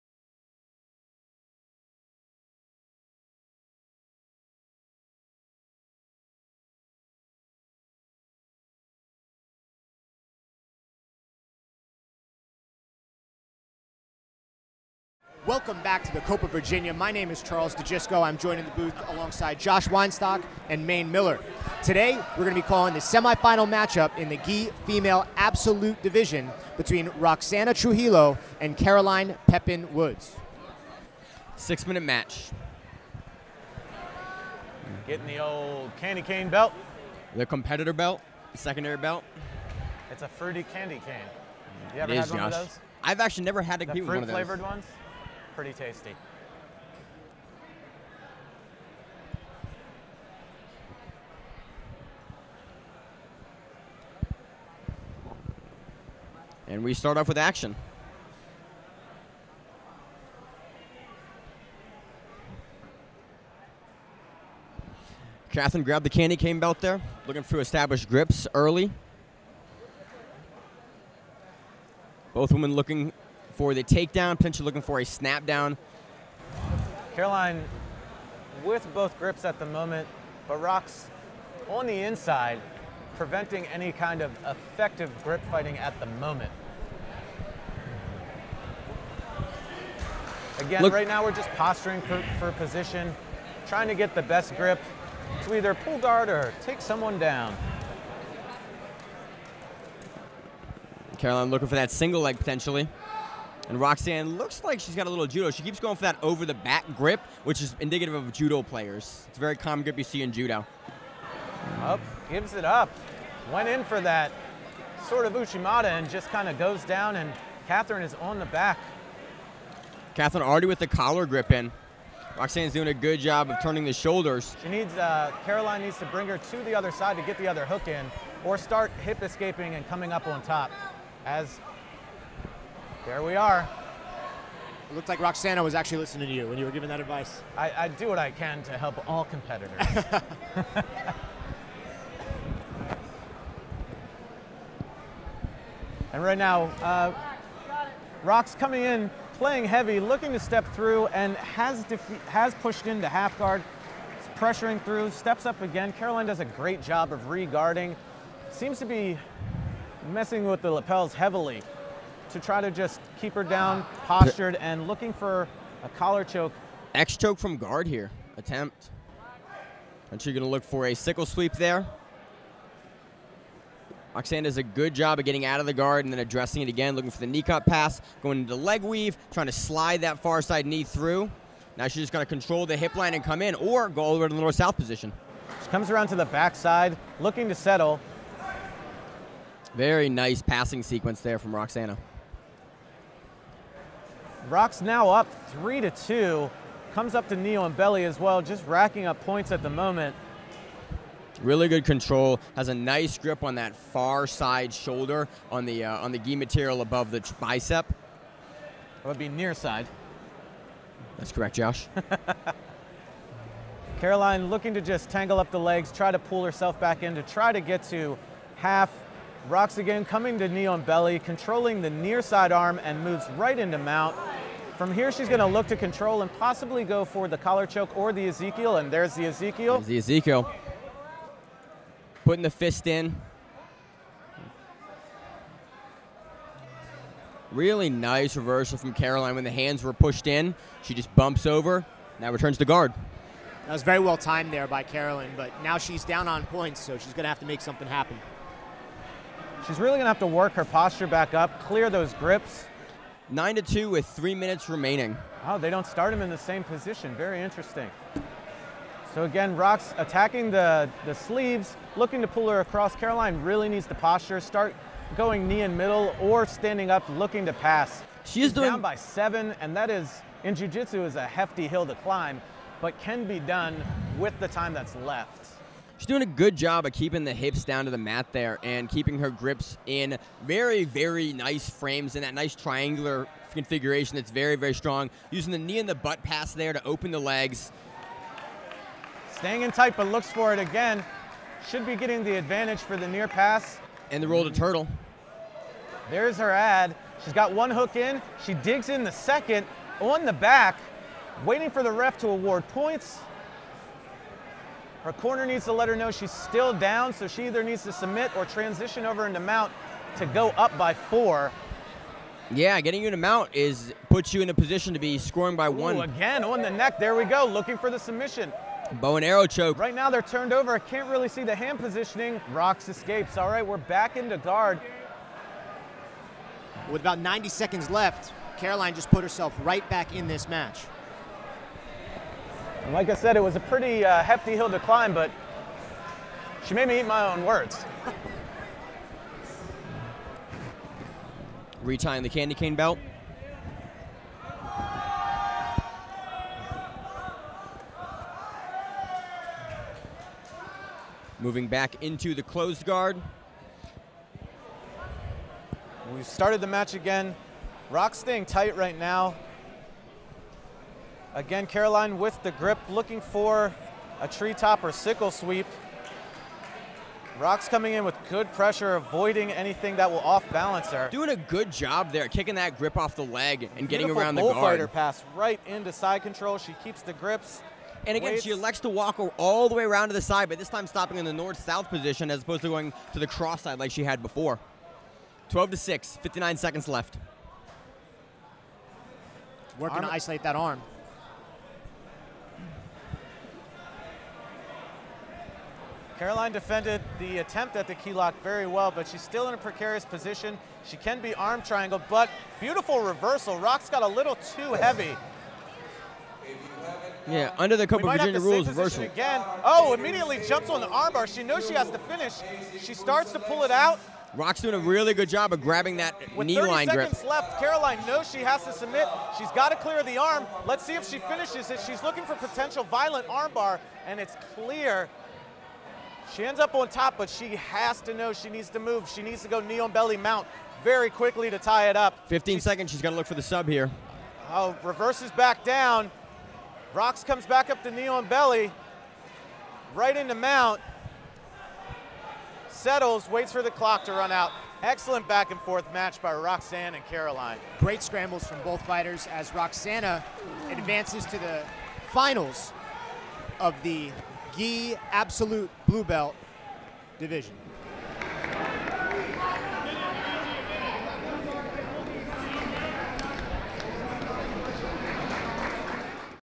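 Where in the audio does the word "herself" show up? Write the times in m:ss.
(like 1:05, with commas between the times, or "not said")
3:36, 5:29.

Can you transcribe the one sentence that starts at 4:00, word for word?
She just bumps over, now returns to guard.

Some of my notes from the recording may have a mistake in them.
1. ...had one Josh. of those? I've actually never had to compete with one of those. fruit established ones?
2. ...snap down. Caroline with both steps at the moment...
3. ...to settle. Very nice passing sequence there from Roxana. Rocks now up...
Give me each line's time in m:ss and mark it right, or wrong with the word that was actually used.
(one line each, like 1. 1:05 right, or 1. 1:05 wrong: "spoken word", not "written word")
1. 0:42 wrong: "flavored", not "established"
2. 1:15 wrong: "grips", not "steps"
3. 3:07 right.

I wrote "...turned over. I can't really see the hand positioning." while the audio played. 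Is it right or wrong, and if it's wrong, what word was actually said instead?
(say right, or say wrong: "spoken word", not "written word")
right.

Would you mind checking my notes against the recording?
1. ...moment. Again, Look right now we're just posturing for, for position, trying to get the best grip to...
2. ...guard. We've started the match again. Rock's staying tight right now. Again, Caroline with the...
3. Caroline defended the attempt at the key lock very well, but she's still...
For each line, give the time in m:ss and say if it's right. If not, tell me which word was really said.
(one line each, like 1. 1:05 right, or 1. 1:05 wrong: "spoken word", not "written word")
1. 1:26 right
2. 5:52 right
3. 6:36 right.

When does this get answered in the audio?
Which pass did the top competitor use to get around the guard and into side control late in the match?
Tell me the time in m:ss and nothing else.
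6:14.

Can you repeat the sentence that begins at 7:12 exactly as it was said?
15 she's, seconds, she's gonna look for the sub here.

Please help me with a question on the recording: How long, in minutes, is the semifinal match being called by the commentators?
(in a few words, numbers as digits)
6.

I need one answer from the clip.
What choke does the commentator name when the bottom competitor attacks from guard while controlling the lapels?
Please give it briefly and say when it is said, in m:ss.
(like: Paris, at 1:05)
X choke, at 2:46.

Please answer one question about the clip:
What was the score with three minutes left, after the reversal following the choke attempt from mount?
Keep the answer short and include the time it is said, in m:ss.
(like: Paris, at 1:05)
9 to 2, at 4:13.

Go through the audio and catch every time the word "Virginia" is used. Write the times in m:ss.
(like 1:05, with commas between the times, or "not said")
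0:16, 6:48.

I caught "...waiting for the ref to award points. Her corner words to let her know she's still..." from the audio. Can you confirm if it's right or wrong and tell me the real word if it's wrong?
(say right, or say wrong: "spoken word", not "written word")
wrong: "needs", not "words".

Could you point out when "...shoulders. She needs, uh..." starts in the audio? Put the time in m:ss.
2:03.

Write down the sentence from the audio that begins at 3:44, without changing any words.
From here, she's going to look to control and possibly go for the collar choke or the Ezekiel, and there's the Ezekiel.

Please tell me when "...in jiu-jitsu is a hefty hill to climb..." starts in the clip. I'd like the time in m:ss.
4:30.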